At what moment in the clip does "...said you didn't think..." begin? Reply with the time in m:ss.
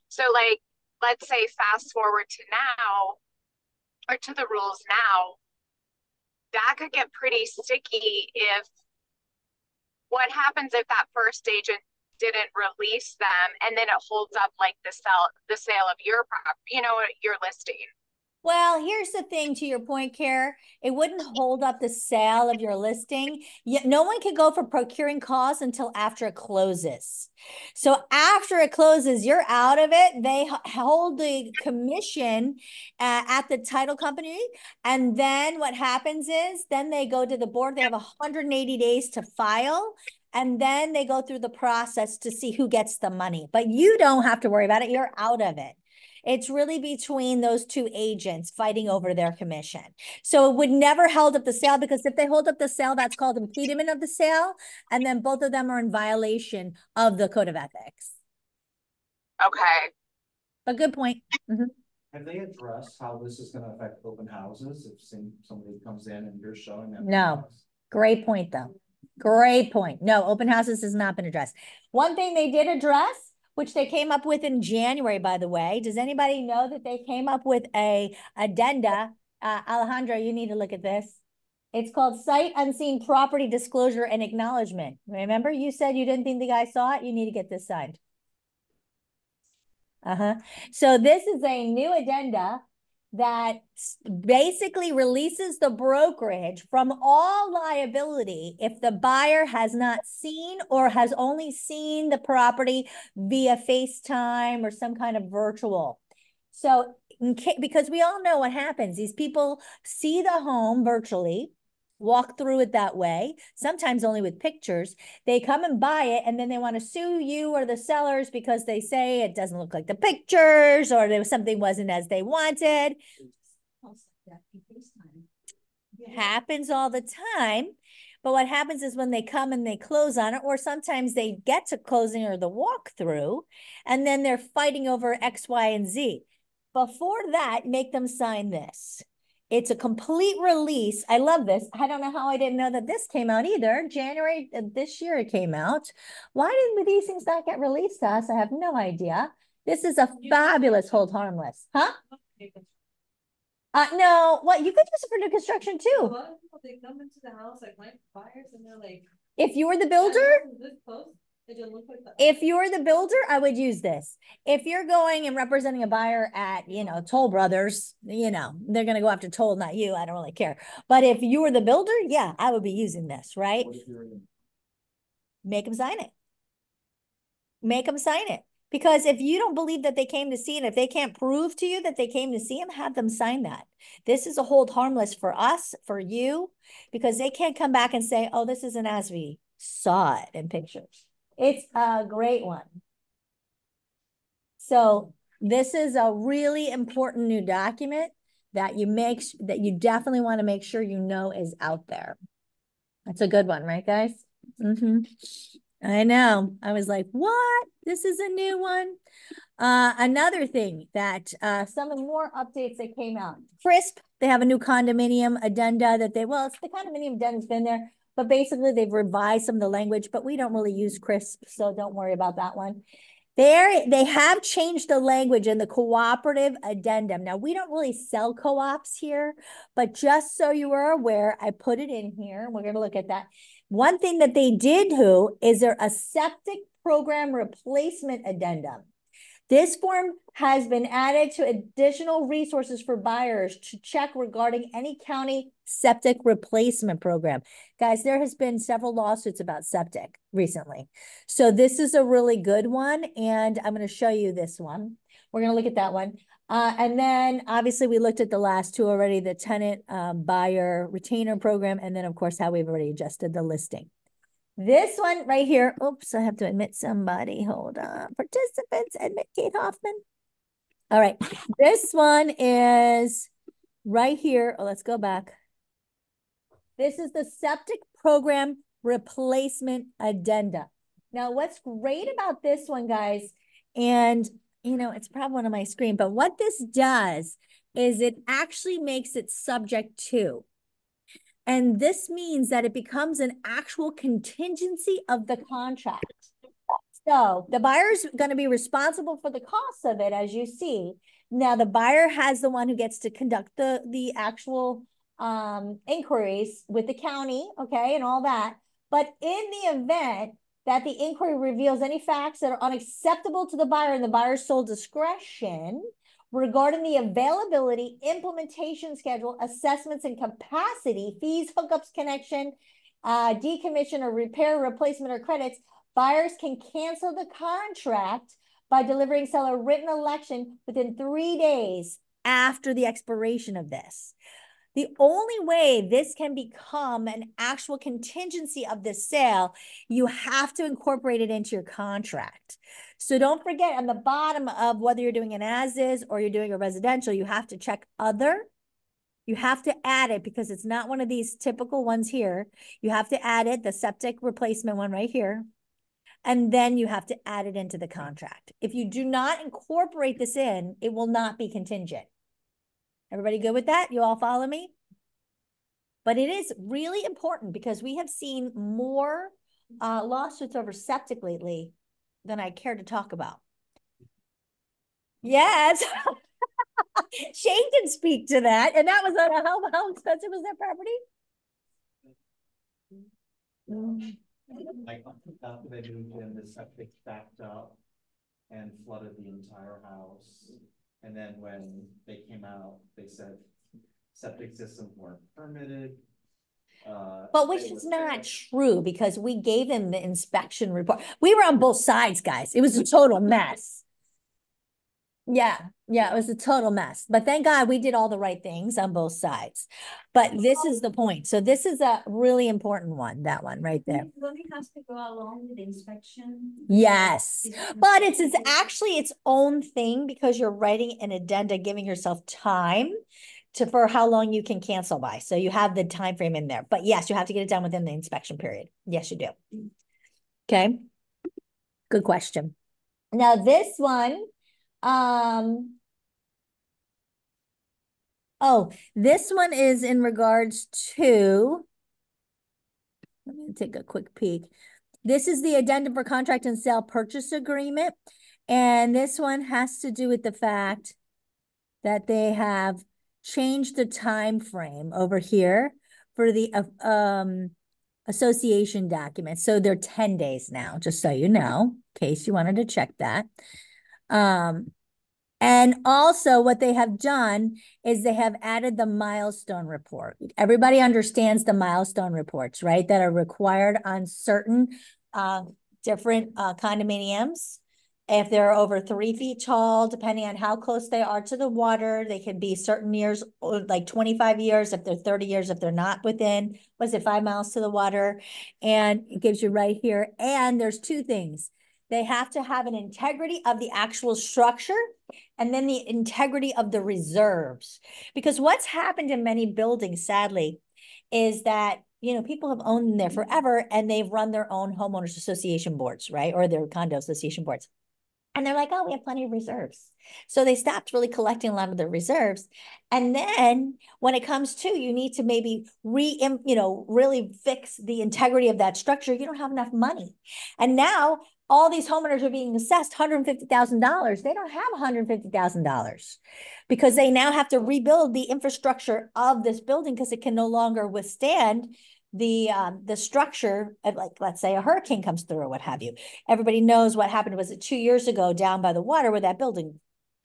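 1:25.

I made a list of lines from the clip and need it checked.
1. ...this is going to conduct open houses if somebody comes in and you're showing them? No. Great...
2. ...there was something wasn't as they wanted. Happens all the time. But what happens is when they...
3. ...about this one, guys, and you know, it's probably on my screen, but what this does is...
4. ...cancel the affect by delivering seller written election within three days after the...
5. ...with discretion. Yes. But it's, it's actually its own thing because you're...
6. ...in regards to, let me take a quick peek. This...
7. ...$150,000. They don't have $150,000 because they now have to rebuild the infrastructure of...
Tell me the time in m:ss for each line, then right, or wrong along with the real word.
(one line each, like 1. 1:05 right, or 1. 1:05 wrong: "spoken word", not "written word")
1. 1:03 wrong: "affect", not "conduct"
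2. 2:01 right
3. 4:42 right
4. 5:26 wrong: "contract", not "affect"
5. 6:55 wrong: "inspection", not "discretion"
6. 7:19 right
7. 8:42 right.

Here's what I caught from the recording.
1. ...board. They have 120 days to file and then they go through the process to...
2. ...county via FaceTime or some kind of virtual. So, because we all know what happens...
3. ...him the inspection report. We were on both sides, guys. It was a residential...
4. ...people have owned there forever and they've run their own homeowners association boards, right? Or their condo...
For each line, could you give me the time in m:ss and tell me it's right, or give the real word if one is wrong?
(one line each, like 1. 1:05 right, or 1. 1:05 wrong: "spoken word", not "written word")
1. 0:37 wrong: "180", not "120"
2. 1:42 wrong: "property", not "county"
3. 6:39 wrong: "total", not "residential"
4. 8:22 right.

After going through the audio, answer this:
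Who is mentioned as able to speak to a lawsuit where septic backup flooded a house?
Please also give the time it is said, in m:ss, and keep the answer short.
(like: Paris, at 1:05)
Shane, at 6:17.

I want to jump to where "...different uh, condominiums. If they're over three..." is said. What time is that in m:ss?
7:55.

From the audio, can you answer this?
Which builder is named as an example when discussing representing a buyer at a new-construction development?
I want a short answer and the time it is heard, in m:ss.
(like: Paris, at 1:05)
Toll Brothers, at 2:47.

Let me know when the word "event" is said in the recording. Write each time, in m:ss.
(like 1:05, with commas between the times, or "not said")
5:09.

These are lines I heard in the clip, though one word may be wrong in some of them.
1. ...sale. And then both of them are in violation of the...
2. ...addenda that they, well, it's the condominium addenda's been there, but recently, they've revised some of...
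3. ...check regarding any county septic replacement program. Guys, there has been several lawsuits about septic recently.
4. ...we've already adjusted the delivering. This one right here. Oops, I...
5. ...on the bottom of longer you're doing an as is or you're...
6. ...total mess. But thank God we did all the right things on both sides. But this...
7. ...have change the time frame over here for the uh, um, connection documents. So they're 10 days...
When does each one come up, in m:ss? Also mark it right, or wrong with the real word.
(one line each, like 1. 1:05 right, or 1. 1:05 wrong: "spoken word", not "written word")
1. 0:54 right
2. 3:35 wrong: "basically", not "recently"
3. 4:03 right
4. 4:22 wrong: "listing", not "delivering"
5. 5:43 wrong: "whether", not "longer"
6. 6:46 right
7. 7:32 wrong: "association", not "connection".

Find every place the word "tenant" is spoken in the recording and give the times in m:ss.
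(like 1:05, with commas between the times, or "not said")
4:19.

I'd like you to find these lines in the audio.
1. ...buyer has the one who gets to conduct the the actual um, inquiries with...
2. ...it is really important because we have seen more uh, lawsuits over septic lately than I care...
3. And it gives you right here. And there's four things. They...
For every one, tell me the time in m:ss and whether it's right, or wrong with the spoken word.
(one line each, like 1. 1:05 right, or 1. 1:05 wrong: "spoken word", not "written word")
1. 5:01 right
2. 6:06 right
3. 8:08 wrong: "two", not "four".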